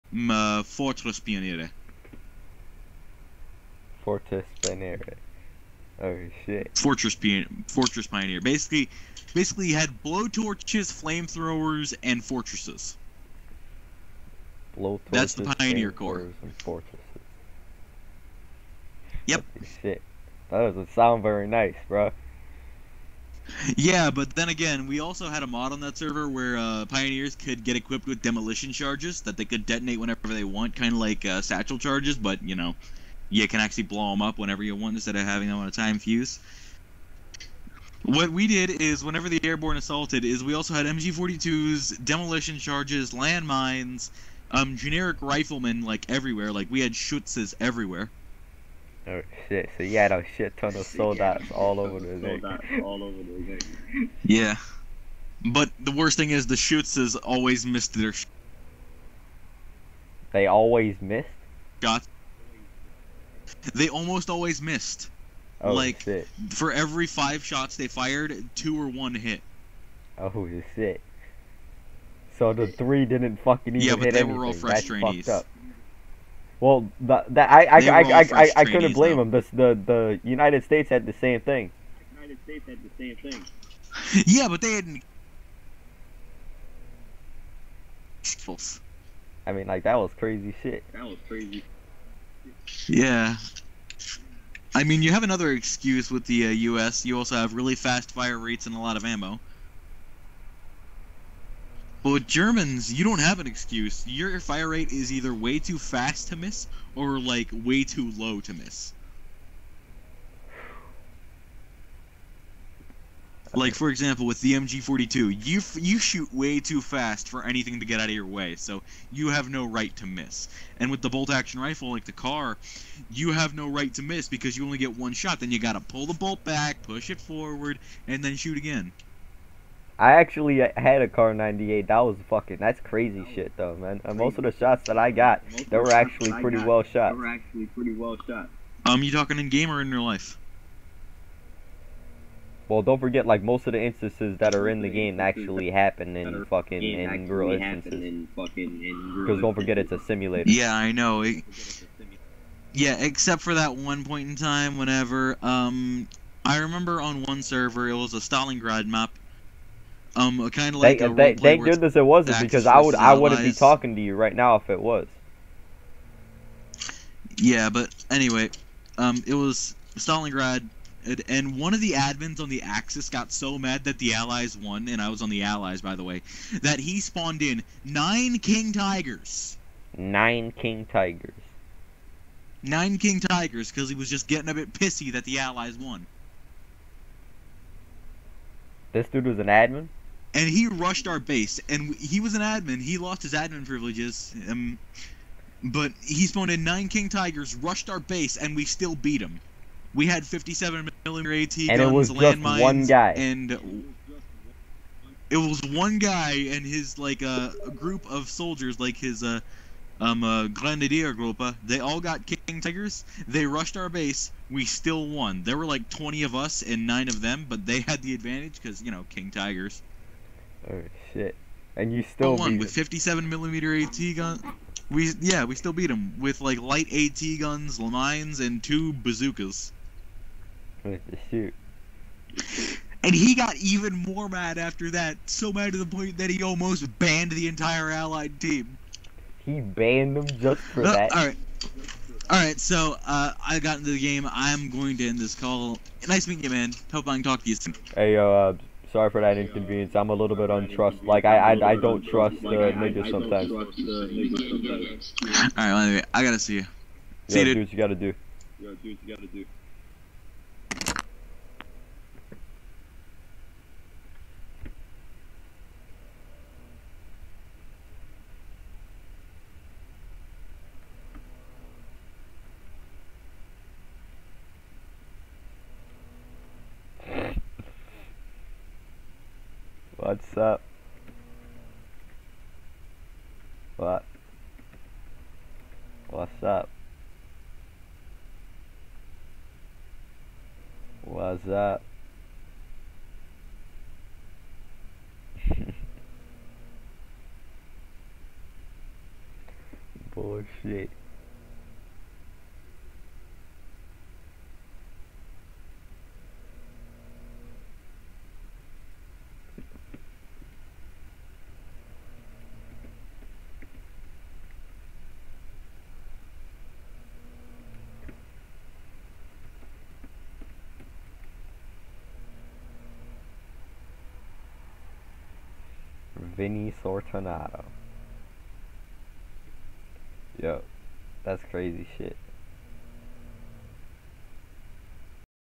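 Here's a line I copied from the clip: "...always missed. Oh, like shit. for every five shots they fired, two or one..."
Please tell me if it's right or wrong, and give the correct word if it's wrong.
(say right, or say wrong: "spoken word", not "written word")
right.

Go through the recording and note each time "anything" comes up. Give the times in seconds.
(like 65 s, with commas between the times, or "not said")
74 s, 117 s.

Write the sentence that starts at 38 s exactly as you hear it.
What we did is, whenever the airborne assaulted, is we also had MG42s, demolition charges, landmines, um, generic riflemen like everywhere.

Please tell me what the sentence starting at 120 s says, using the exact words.
And with the bolt-action rifle, like the Kar, you have no right to miss because you only get one shot.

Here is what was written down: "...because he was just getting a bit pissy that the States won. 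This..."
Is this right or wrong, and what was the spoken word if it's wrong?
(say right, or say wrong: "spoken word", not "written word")
wrong: "Allies", not "States".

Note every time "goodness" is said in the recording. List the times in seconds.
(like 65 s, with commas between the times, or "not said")
161 s.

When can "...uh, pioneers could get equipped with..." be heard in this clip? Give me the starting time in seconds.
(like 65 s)
26 s.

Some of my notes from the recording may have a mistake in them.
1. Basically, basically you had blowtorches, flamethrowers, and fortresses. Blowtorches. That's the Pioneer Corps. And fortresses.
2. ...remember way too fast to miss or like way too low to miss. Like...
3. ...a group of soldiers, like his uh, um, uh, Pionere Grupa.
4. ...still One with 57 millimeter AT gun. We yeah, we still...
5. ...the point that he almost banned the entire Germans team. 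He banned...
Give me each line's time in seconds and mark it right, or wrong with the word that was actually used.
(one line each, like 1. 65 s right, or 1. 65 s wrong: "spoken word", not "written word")
1. 8 s right
2. 105 s wrong: "either", not "remember"
3. 207 s wrong: "Grenadier", not "Pionere"
4. 222 s right
5. 235 s wrong: "Allied", not "Germans".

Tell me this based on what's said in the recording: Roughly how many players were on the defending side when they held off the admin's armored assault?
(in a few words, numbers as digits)
20.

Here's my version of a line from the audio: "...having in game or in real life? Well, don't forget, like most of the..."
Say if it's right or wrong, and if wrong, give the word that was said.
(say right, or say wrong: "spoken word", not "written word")
wrong: "talking", not "having".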